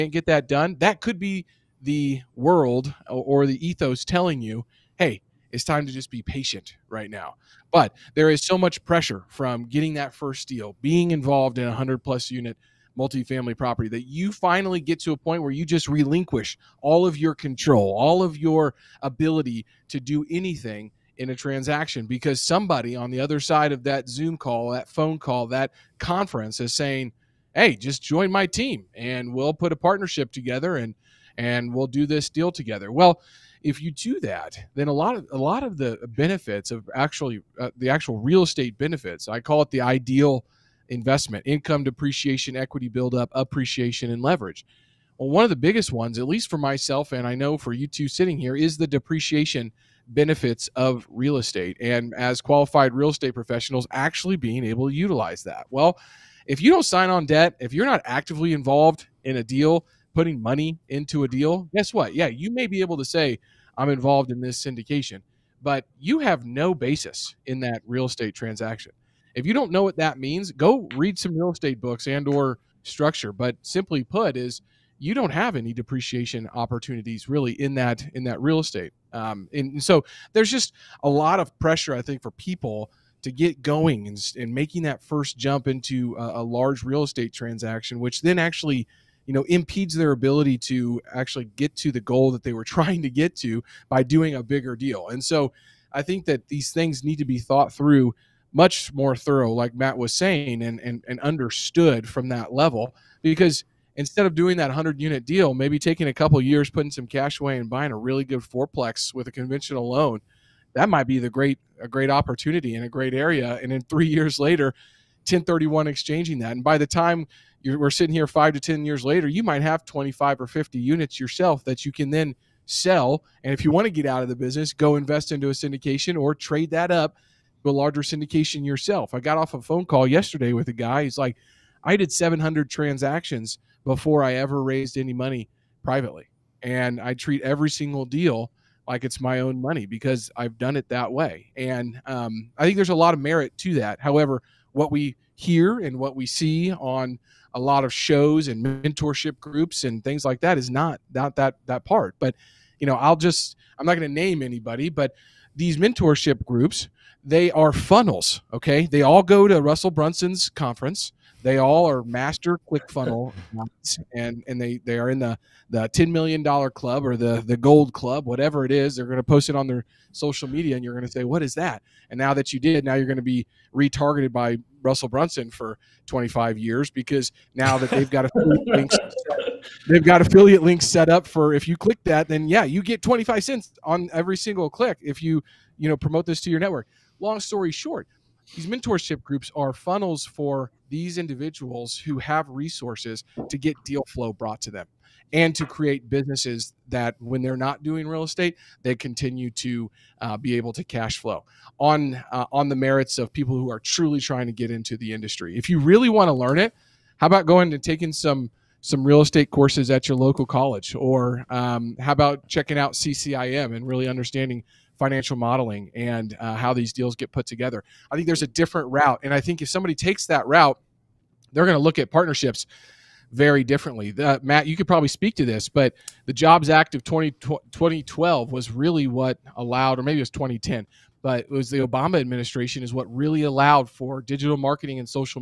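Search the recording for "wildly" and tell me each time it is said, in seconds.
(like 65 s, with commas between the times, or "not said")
not said.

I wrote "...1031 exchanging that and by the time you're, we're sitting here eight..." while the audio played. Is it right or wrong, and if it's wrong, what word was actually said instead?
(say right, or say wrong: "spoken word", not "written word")
wrong: "five", not "eight".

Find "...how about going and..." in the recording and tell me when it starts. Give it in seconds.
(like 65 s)
207 s.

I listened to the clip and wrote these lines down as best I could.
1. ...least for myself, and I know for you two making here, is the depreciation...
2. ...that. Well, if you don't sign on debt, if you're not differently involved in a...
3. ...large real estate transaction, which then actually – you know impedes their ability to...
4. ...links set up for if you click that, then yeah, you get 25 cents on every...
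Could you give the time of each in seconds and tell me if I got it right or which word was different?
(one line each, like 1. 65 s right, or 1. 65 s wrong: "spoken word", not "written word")
1. 46 s wrong: "sitting", not "making"
2. 55 s wrong: "actively", not "differently"
3. 86 s right
4. 180 s right.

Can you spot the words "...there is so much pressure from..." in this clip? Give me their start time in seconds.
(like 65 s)
8 s.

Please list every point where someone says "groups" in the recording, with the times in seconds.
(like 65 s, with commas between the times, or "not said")
149 s, 156 s, 189 s.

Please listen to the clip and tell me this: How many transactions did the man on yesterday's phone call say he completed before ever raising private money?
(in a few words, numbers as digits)
700.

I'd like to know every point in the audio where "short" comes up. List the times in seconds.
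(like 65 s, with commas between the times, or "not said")
187 s.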